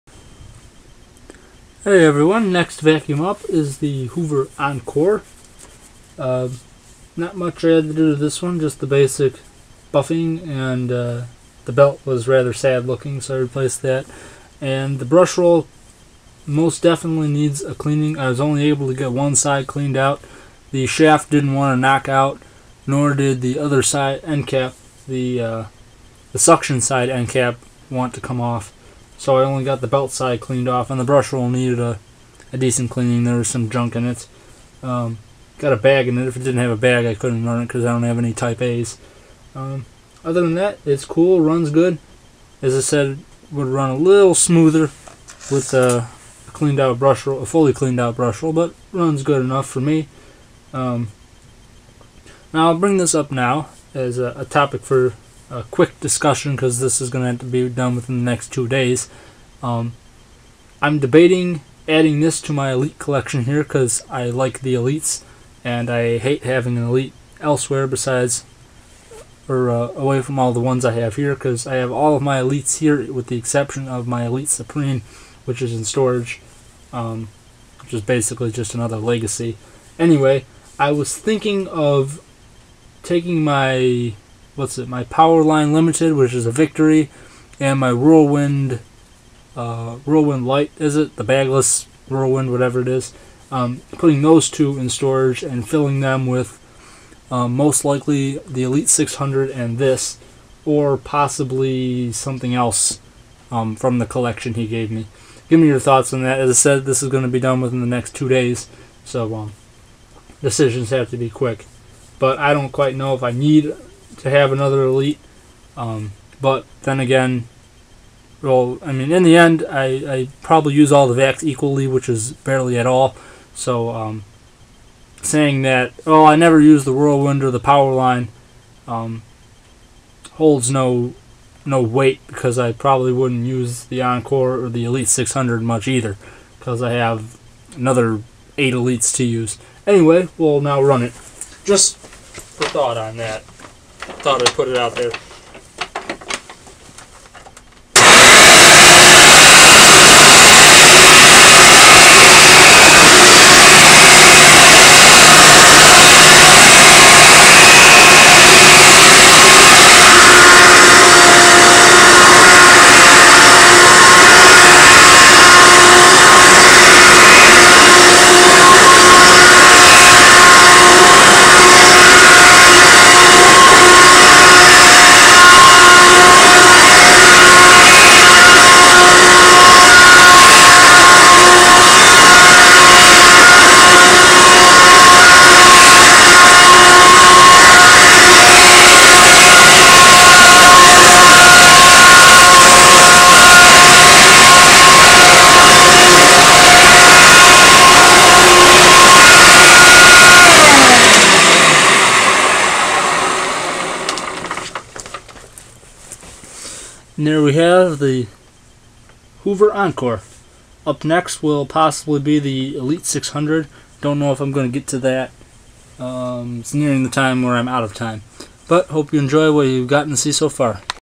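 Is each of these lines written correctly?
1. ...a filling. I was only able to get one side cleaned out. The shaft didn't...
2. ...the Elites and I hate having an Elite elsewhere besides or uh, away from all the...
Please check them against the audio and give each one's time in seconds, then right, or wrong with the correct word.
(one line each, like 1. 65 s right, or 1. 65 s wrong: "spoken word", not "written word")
1. 17 s wrong: "cleaning", not "filling"
2. 64 s right.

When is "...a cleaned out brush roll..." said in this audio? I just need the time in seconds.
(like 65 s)
45 s.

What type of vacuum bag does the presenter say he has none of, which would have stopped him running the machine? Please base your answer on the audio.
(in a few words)
Type A.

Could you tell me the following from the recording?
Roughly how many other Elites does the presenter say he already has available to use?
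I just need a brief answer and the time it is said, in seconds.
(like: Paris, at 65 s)
8, at 138 s.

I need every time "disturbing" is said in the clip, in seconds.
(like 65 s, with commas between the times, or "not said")
not said.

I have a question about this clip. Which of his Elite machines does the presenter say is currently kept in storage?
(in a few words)
Elite Supreme.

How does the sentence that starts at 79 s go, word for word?
Anyway, I was thinking of taking my what's it?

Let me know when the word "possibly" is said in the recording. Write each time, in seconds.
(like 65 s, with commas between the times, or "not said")
100 s, 211 s.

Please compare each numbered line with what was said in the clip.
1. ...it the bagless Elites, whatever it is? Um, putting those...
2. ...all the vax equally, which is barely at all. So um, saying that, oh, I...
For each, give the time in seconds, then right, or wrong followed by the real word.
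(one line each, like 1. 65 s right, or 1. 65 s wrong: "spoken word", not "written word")
1. 90 s wrong: "Whirlwind", not "Elites"
2. 120 s right.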